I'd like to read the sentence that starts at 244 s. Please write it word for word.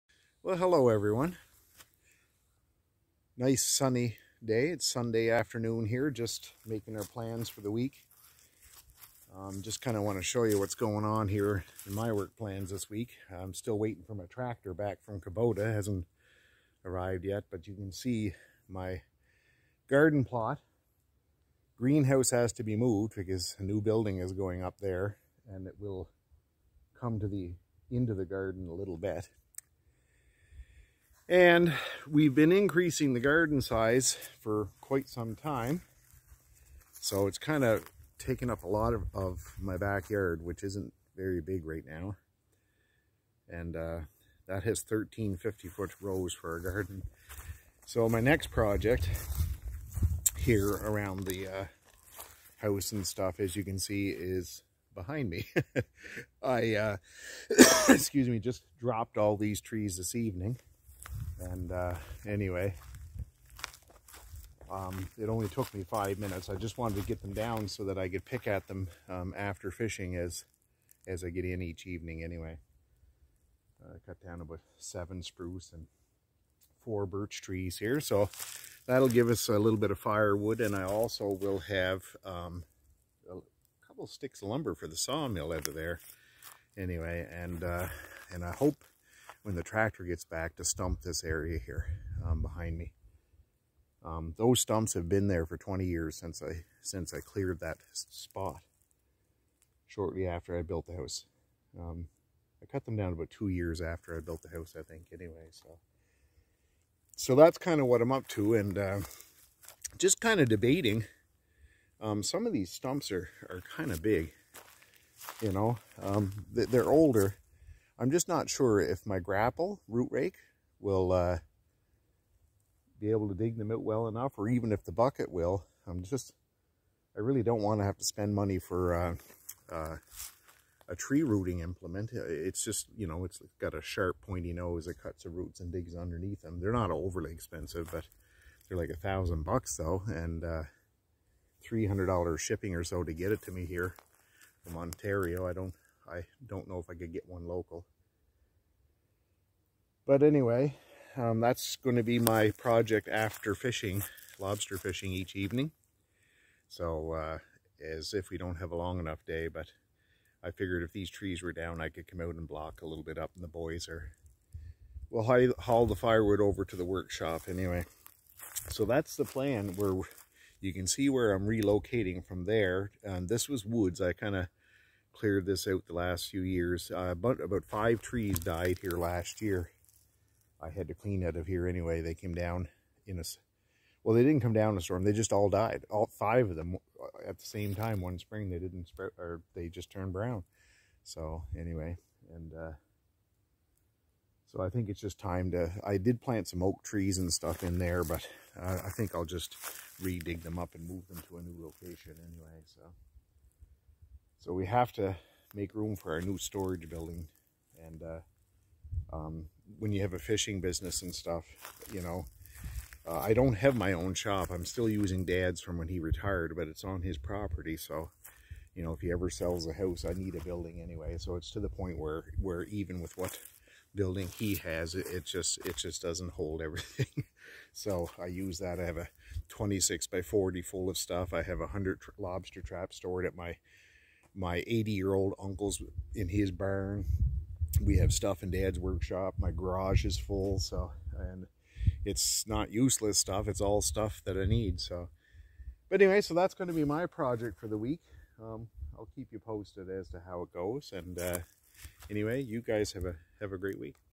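So, but anyway, so that's going to be my project for the week.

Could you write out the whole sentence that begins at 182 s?
They came down in a, well, they didn't come down in a storm.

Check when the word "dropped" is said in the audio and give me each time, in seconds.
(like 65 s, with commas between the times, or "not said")
58 s.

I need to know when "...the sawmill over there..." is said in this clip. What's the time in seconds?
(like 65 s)
84 s.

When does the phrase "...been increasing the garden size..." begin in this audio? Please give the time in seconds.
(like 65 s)
32 s.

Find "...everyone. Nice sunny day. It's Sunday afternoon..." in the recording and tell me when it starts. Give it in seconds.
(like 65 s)
0 s.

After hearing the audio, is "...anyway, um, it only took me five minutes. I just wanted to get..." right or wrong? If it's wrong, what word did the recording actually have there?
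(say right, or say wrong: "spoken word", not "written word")
right.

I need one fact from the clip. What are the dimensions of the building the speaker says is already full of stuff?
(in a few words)
26 by 40.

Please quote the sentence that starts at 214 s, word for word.
I'm still using dad's from when he retired, but it's on his property.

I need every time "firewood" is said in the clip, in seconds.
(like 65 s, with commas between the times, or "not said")
79 s, 165 s.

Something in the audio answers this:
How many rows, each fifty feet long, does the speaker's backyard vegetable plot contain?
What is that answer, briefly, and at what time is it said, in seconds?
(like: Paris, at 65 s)
13, at 44 s.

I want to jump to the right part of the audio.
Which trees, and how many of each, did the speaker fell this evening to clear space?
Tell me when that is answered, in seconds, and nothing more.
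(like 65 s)
74 s.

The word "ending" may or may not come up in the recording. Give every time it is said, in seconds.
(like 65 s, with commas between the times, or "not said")
not said.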